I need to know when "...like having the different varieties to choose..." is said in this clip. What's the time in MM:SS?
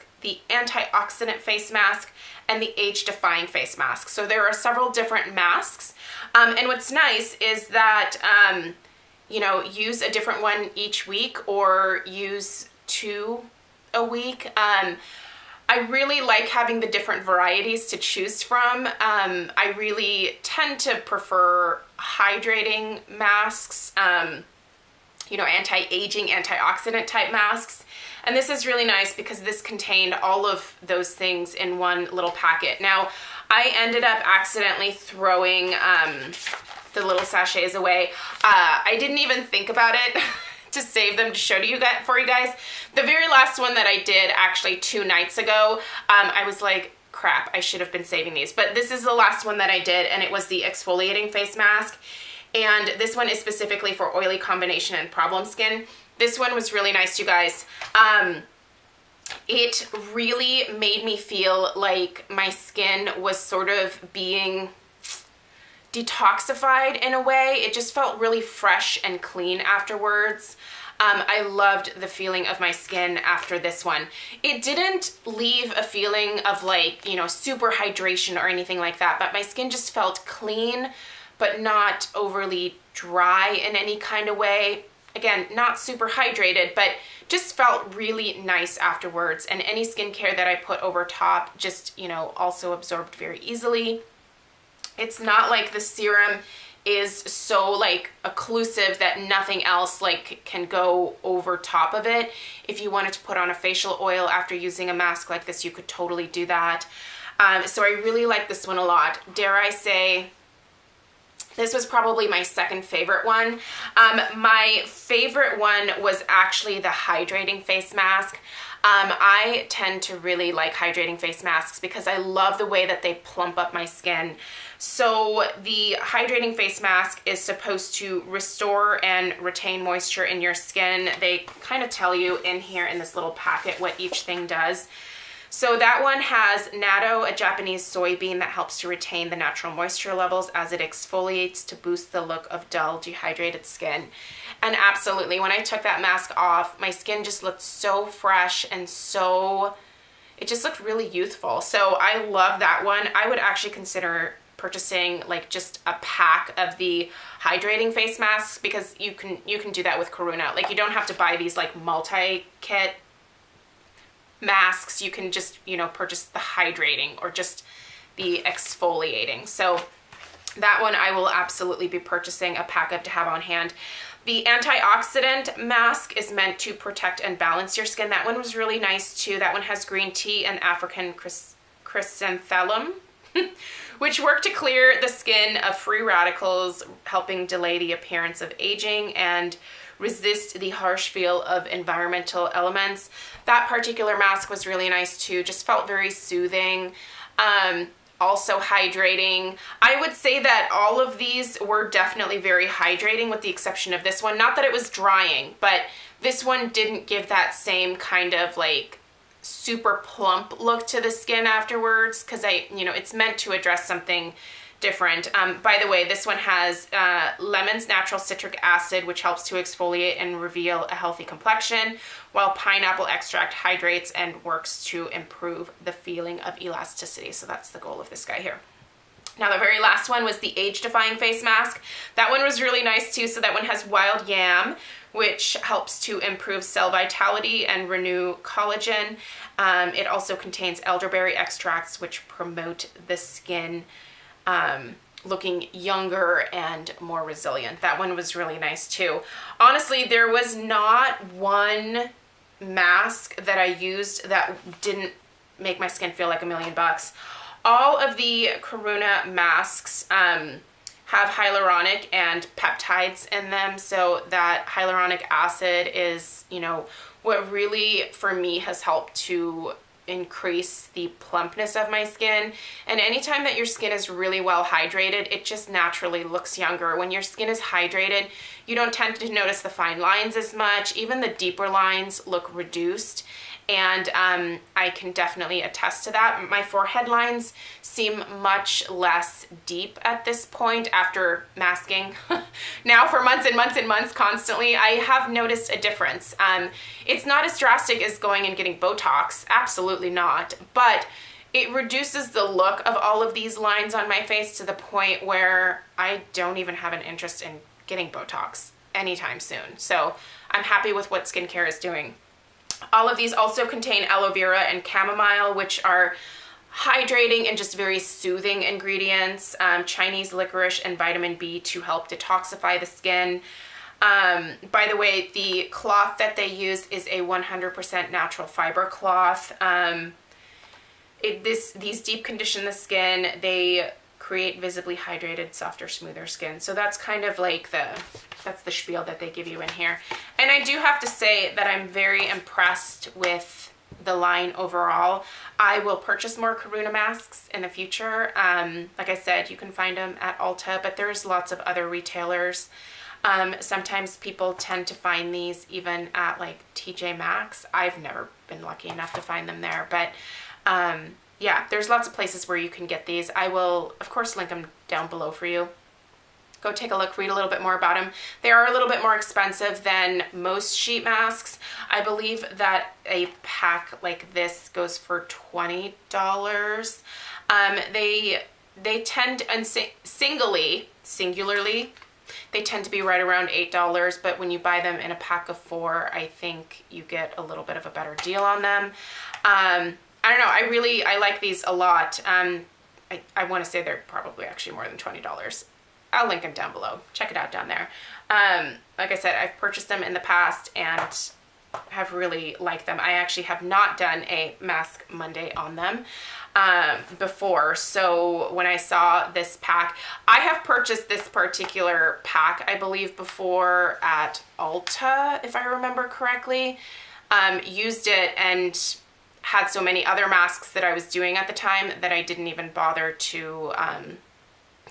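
00:16.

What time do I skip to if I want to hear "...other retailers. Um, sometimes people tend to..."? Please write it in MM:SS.
05:51.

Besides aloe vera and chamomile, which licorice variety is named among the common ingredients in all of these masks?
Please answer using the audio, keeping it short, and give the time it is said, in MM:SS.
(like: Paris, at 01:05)
Chinese licorice, at 05:19.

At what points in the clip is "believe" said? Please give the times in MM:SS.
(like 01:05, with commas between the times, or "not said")
06:12, 06:52.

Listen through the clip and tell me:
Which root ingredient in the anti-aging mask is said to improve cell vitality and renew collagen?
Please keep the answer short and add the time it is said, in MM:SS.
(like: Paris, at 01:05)
wild yam, at 03:53.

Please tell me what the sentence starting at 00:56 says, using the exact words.
This one was really nice, you guys.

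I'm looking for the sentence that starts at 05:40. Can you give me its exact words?
And I do have to say that I'm very impressed with the line overall.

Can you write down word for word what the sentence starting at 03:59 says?
Um, it also contains elderberry extracts, which promote the skin um, looking younger and more resilient.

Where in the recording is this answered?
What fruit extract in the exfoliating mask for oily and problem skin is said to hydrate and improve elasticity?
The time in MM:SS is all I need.
03:42.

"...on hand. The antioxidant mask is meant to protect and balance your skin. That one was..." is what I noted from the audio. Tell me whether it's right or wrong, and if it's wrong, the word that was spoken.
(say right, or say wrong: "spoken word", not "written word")
right.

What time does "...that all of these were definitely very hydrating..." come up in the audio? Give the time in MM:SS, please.
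03:20.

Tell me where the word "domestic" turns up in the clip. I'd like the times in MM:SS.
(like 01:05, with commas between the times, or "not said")
not said.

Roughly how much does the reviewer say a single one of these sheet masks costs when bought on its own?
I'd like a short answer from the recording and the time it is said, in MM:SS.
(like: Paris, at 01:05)
$8, at 06:23.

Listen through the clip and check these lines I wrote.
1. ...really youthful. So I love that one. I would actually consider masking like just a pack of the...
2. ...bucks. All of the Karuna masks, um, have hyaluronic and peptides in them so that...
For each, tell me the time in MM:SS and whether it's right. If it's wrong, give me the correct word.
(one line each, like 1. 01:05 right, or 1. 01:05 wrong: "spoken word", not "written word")
1. 02:30 wrong: "purchasing", not "masking"
2. 04:16 right.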